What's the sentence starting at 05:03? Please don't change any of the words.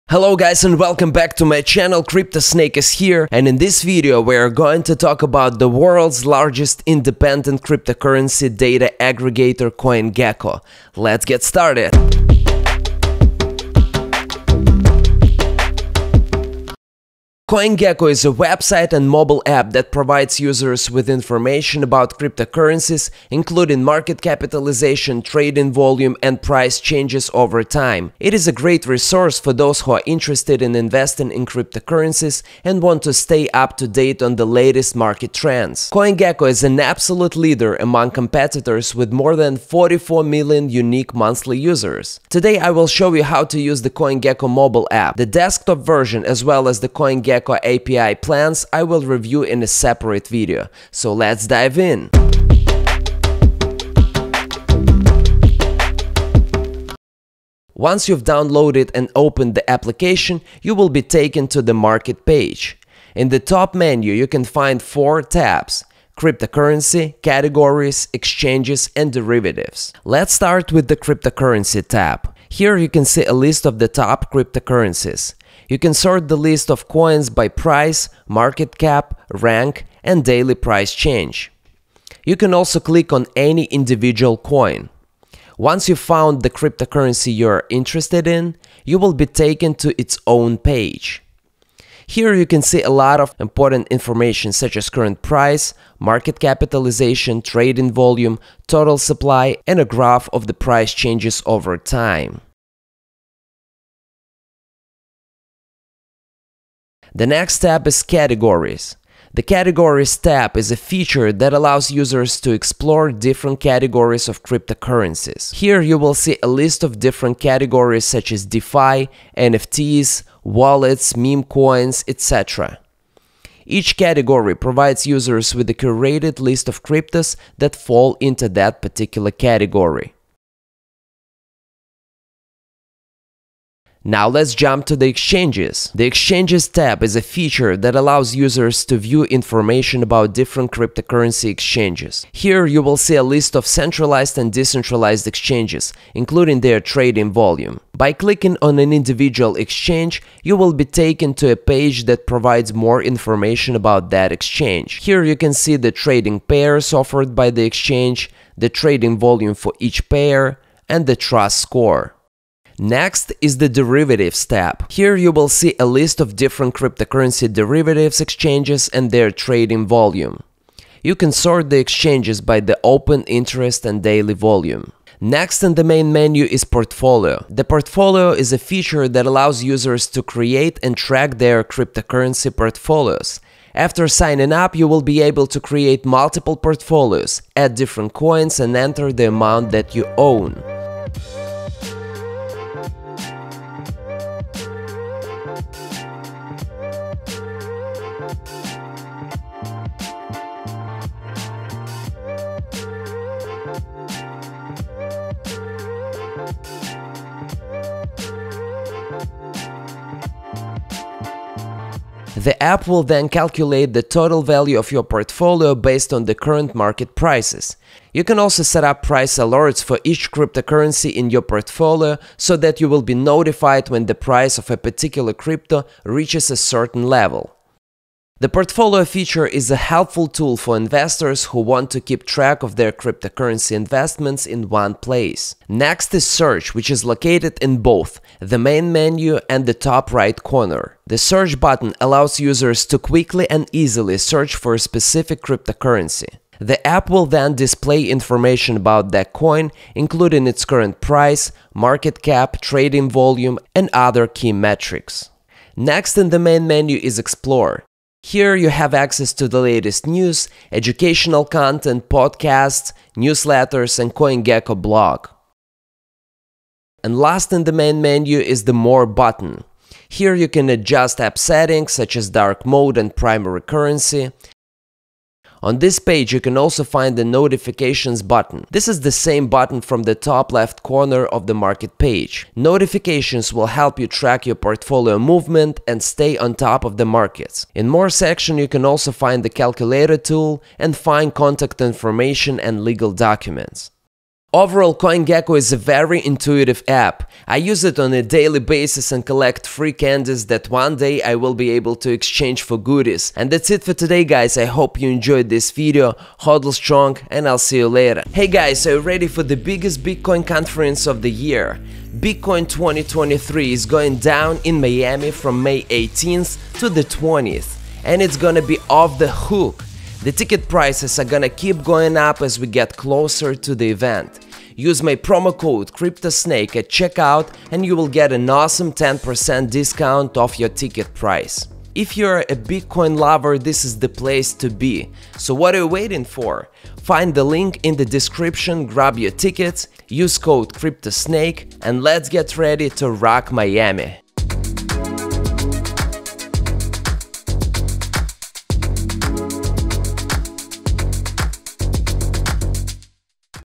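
And that's it for today guys, I hope you enjoyed this video, hodl strong and I'll see you later.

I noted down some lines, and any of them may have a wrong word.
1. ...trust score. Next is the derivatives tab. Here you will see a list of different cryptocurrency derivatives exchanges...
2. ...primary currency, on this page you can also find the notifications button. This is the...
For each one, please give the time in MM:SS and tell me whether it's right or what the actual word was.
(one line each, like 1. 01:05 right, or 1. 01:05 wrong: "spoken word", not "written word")
1. 02:41 right
2. 04:33 right.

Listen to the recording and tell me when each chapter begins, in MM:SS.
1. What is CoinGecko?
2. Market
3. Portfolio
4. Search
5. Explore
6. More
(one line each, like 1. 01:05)
1. 00:18
2. 00:54
3. 02:55
4. 03:56
5. 04:17
6. 04:27.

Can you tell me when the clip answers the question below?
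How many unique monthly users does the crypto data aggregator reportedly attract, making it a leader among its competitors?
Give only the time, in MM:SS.
00:39.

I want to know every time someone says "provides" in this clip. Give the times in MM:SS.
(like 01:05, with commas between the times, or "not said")
00:19, 02:04, 02:32.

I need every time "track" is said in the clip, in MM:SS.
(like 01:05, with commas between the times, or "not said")
03:00, 03:52, 04:44.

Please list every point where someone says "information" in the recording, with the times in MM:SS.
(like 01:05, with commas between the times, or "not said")
00:21, 01:33, 02:19, 02:33, 04:08, 04:51.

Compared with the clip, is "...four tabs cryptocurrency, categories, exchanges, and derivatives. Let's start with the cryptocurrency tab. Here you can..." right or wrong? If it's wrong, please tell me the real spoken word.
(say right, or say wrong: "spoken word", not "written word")
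right.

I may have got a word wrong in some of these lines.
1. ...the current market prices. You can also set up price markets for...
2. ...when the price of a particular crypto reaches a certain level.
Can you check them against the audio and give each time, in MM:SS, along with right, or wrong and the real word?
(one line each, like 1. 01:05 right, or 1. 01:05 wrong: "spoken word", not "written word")
1. 03:36 wrong: "alerts", not "markets"
2. 03:43 right.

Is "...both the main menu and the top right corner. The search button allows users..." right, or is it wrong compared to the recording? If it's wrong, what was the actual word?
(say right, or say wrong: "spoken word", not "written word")
right.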